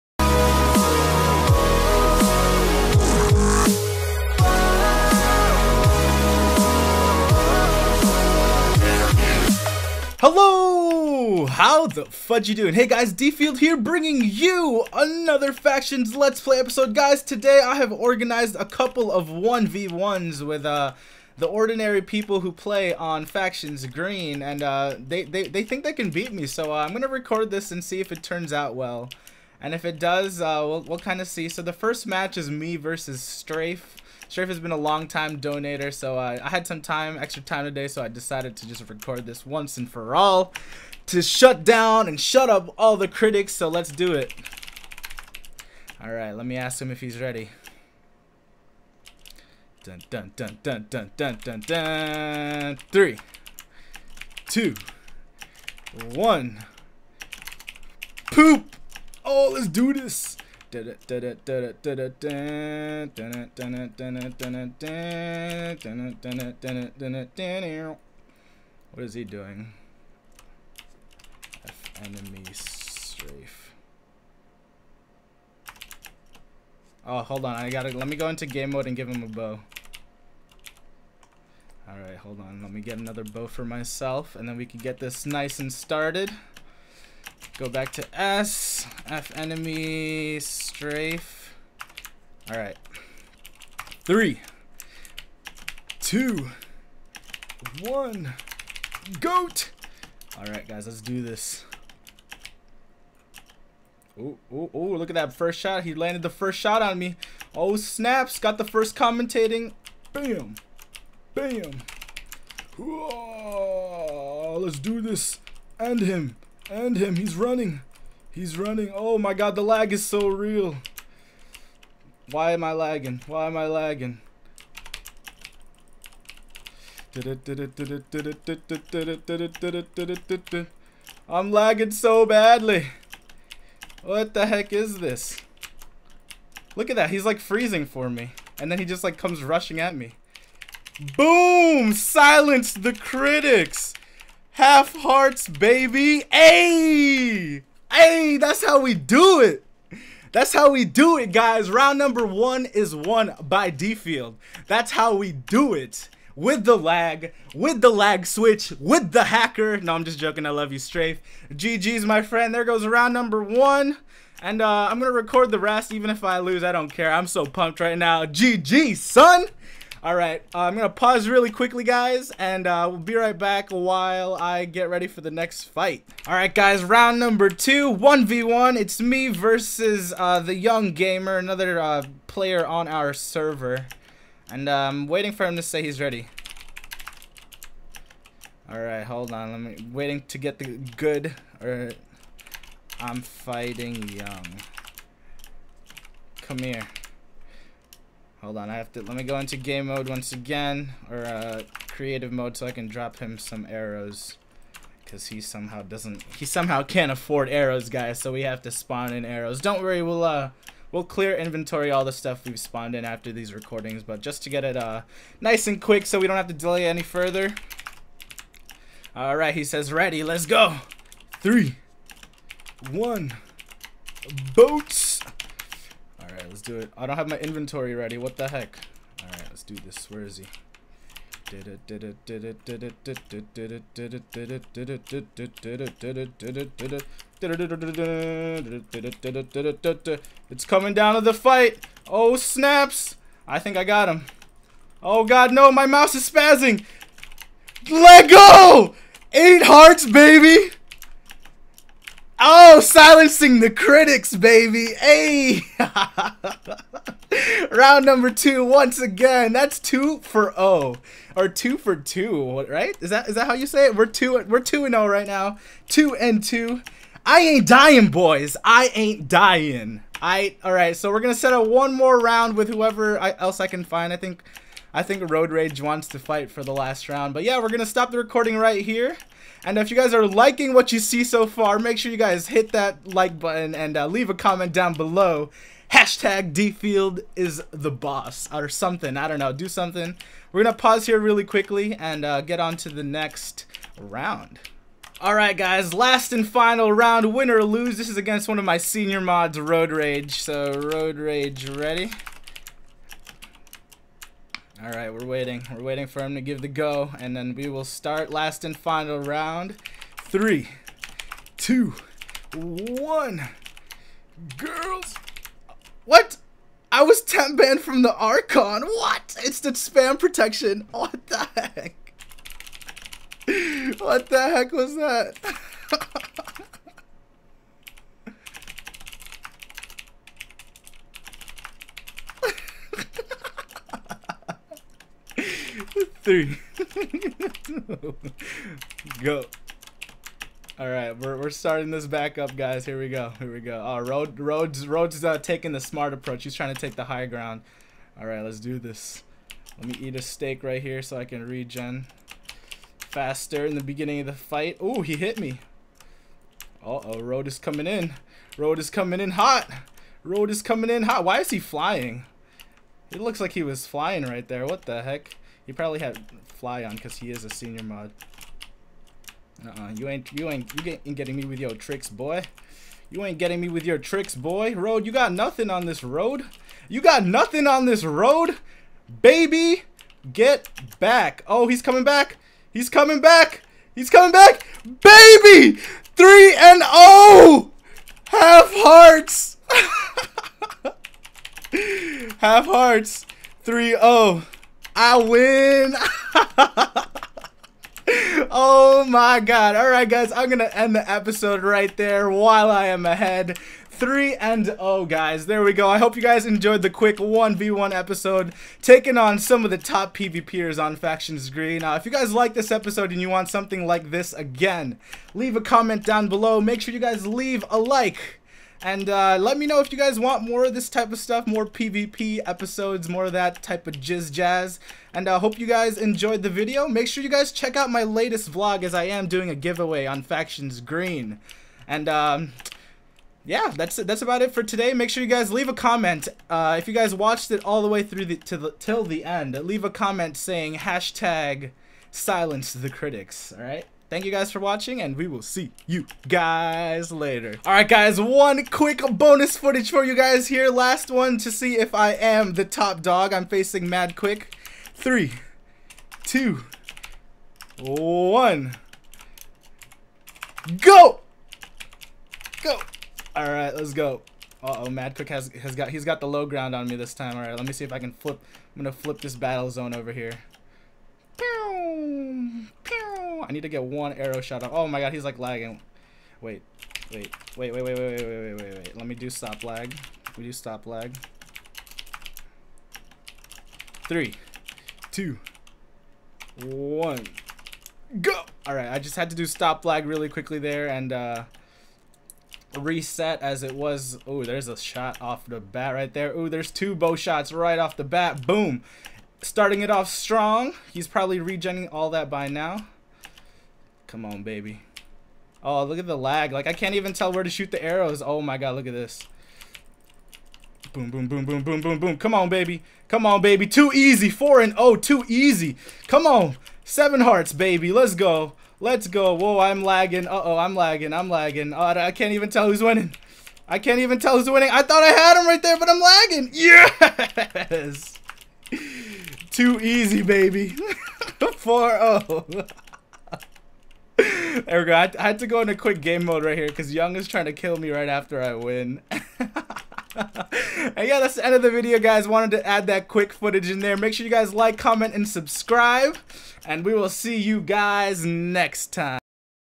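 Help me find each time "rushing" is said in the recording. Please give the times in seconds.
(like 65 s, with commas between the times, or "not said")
139 s.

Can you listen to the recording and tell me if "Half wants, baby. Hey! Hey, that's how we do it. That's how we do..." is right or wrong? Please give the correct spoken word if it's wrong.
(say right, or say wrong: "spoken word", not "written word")
wrong: "hearts", not "wants".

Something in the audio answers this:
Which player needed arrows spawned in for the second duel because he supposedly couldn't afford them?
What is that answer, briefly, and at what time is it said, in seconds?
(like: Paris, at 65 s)
the young gamer, at 180 s.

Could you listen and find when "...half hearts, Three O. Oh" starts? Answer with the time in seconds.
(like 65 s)
392 s.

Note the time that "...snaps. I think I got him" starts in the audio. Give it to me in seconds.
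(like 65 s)
242 s.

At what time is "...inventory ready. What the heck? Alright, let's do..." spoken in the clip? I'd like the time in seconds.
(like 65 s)
227 s.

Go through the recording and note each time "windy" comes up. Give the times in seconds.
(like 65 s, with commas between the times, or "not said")
not said.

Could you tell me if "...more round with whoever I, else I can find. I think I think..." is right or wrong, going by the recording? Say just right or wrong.
right.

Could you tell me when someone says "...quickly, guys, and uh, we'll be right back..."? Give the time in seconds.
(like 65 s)
171 s.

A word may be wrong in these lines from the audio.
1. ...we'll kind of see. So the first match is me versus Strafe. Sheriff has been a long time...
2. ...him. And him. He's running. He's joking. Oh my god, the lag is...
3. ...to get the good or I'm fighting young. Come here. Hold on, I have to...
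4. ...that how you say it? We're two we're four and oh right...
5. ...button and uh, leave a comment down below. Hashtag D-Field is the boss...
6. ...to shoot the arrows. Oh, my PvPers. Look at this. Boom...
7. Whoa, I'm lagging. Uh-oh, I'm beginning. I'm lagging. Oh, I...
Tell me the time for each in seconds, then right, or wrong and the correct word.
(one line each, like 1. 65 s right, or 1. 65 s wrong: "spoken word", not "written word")
1. 30 s right
2. 116 s wrong: "running", not "joking"
3. 190 s right
4. 263 s wrong: "two", not "four"
5. 283 s right
6. 507 s wrong: "God", not "PvPers"
7. 519 s wrong: "lagging", not "beginning".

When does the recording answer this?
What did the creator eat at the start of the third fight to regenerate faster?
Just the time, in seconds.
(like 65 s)
350 s.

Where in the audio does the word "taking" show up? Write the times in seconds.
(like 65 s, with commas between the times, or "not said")
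345 s, 408 s.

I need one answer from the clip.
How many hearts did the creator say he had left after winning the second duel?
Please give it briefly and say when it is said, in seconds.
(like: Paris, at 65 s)
8, at 249 s.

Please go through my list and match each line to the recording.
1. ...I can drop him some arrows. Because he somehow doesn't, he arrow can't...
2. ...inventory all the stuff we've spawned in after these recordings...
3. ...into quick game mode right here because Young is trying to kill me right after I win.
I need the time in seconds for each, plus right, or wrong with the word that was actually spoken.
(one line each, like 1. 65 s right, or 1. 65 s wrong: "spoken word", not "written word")
1. 202 s wrong: "somehow", not "arrow"
2. 211 s right
3. 535 s right.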